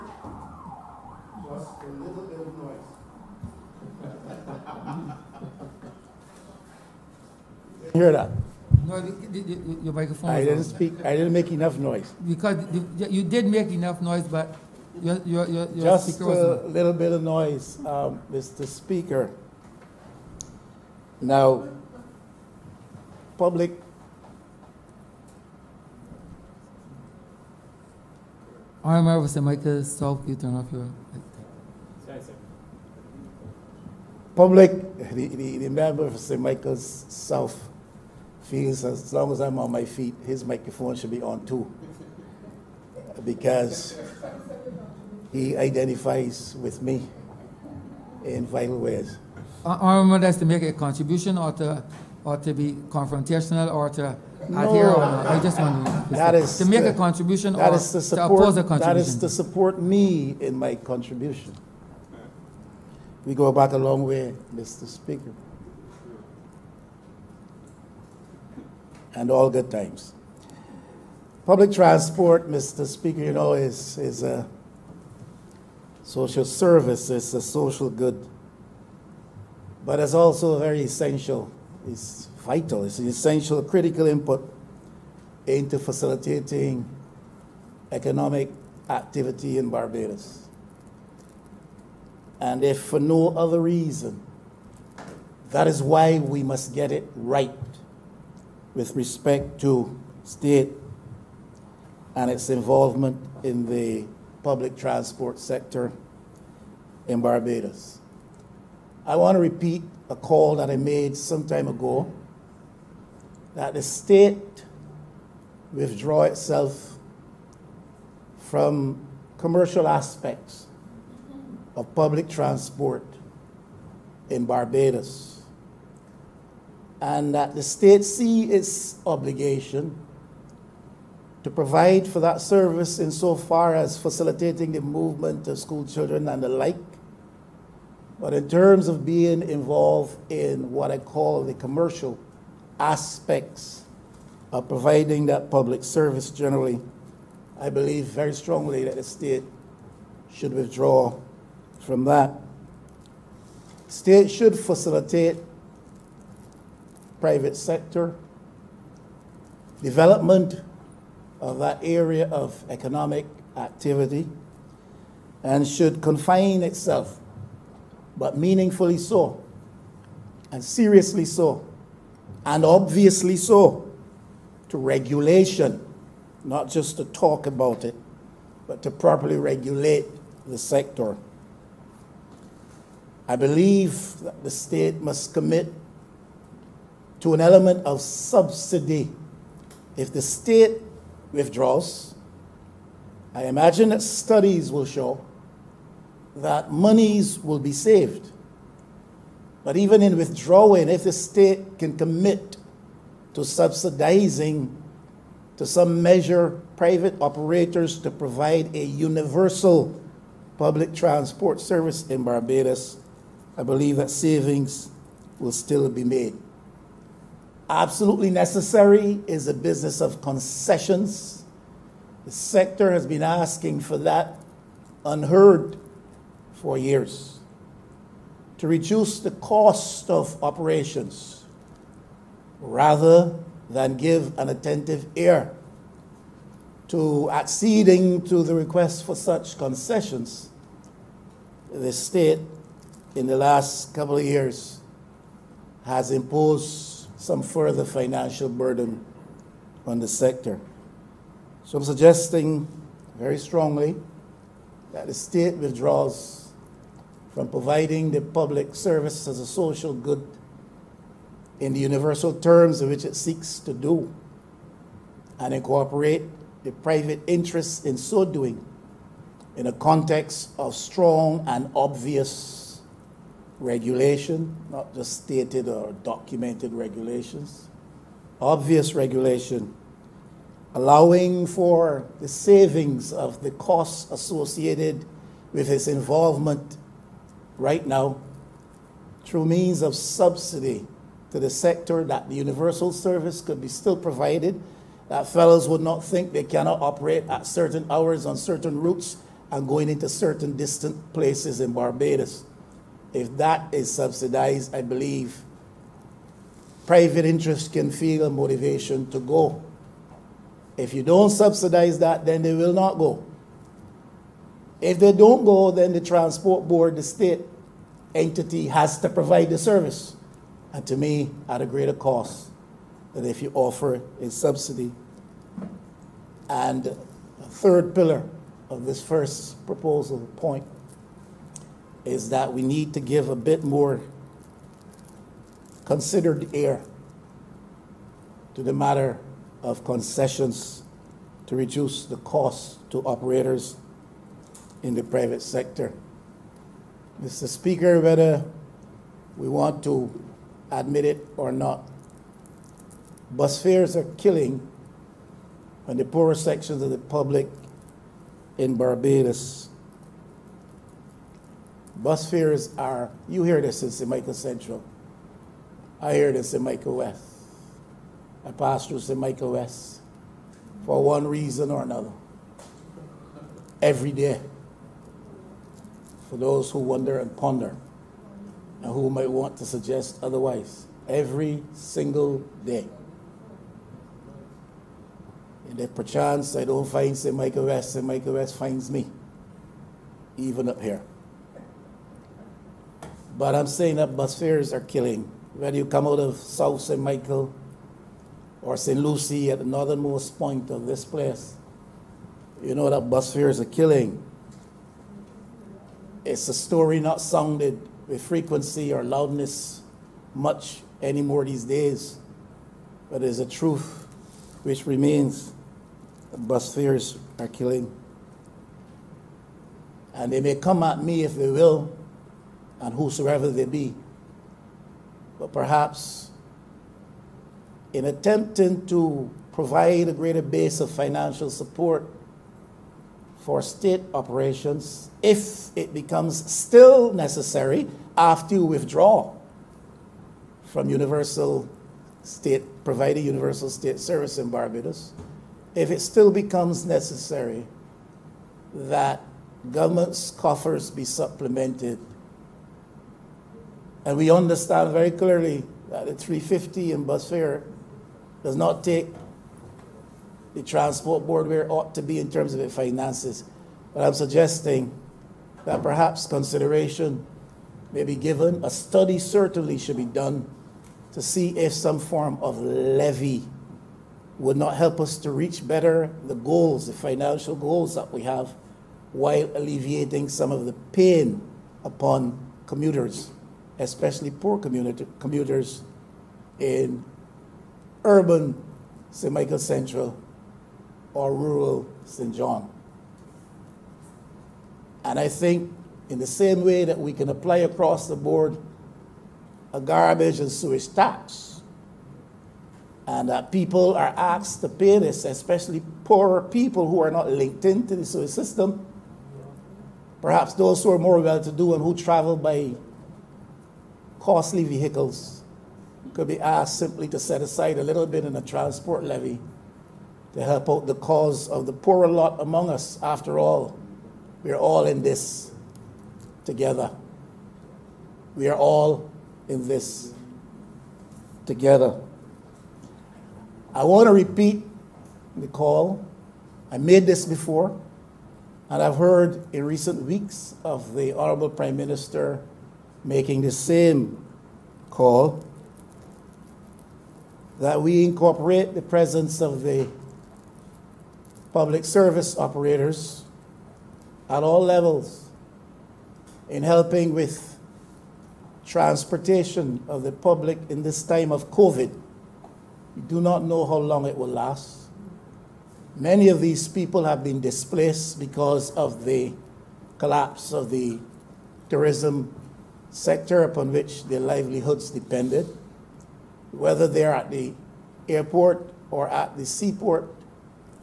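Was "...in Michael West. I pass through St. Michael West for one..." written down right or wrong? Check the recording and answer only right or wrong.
right.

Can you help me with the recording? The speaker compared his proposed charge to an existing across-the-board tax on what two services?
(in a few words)
garbage and sewage.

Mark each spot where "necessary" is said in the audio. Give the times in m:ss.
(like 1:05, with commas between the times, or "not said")
3:38, 7:17, 7:26.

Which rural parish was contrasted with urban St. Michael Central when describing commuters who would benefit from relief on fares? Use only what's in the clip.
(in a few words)
St. John.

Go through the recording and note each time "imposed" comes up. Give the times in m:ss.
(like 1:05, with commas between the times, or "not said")
4:06.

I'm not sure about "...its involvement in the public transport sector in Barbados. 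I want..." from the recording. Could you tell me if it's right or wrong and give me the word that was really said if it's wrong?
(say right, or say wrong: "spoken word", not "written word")
right.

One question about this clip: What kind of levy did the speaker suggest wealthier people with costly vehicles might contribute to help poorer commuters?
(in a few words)
transport levy.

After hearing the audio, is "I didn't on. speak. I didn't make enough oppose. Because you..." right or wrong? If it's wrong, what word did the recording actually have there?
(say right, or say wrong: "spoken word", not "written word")
wrong: "noise", not "oppose".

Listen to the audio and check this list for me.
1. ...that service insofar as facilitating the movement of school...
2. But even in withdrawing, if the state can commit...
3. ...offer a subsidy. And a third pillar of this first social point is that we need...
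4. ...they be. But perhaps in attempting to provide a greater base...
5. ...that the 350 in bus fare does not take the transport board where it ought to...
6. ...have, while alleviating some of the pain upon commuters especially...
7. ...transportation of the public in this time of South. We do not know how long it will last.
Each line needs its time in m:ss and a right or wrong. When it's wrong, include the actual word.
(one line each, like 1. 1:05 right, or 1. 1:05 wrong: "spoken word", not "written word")
1. 2:12 right
2. 3:19 right
3. 5:23 wrong: "proposal", not "social"
4. 7:03 right
5. 7:35 right
6. 7:58 right
7. 9:18 wrong: "COVID", not "South".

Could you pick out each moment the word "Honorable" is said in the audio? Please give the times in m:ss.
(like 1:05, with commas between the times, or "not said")
0:28, 9:01.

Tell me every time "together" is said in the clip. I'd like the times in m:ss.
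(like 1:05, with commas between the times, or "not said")
8:46, 8:51.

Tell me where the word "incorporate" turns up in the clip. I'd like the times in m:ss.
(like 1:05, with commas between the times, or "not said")
4:25, 9:08.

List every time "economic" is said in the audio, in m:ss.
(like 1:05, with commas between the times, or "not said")
1:27, 2:42.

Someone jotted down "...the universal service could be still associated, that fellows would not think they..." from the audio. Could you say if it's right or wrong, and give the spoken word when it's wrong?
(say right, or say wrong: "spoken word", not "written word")
wrong: "provided", not "associated".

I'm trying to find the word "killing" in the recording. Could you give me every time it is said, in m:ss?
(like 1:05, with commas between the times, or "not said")
5:54, 6:34, 6:43, 6:57.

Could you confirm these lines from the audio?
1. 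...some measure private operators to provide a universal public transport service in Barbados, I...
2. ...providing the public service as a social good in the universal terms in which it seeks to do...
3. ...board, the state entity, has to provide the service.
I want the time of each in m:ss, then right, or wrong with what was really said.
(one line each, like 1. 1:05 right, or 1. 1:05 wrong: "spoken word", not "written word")
1. 3:25 right
2. 4:17 right
3. 5:16 right.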